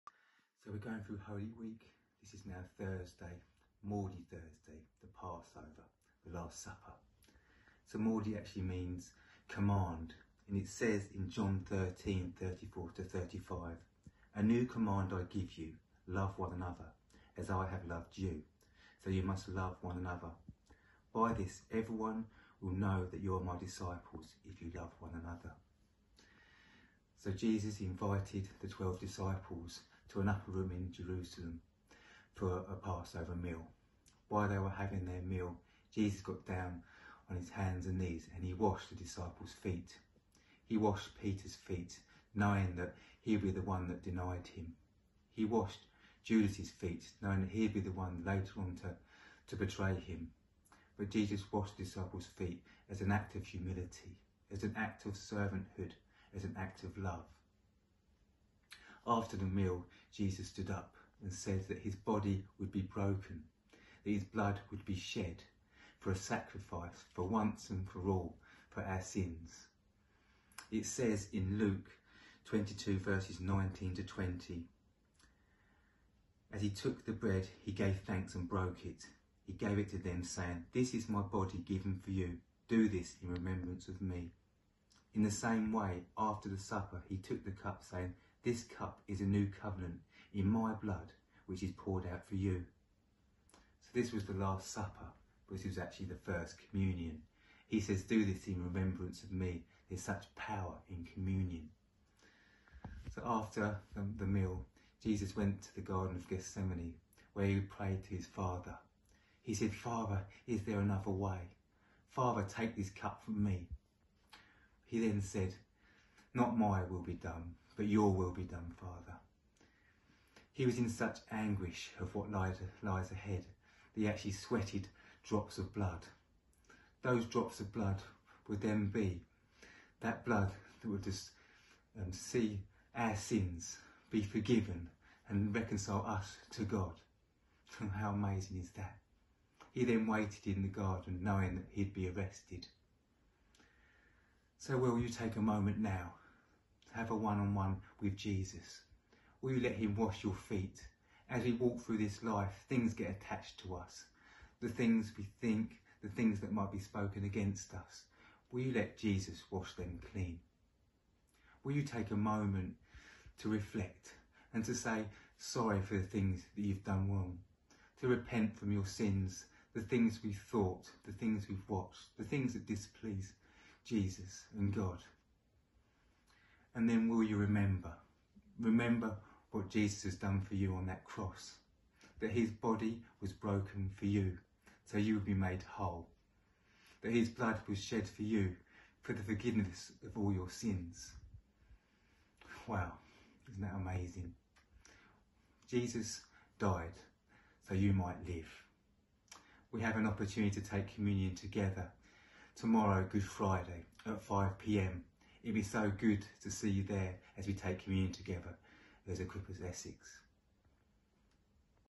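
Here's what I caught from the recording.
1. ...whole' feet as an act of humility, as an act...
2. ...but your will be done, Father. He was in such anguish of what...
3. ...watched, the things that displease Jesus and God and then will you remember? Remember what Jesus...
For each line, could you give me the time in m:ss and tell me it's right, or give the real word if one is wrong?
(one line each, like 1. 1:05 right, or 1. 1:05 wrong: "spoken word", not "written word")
1. 0:51 wrong: "disciples", not "whole"
2. 1:57 right
3. 2:51 right.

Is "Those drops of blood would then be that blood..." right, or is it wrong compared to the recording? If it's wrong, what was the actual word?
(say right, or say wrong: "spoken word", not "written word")
right.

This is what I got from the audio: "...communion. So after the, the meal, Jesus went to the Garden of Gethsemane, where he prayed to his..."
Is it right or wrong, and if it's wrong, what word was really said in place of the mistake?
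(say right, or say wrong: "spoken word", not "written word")
right.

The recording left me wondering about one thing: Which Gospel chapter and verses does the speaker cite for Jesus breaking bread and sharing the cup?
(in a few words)
Luke 22:19-20.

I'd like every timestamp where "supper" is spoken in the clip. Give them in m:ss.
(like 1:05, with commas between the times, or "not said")
0:06, 1:26, 1:34.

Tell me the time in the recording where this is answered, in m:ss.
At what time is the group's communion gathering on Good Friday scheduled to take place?
3:24.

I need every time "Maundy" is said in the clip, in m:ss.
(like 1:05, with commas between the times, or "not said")
0:03, 0:07.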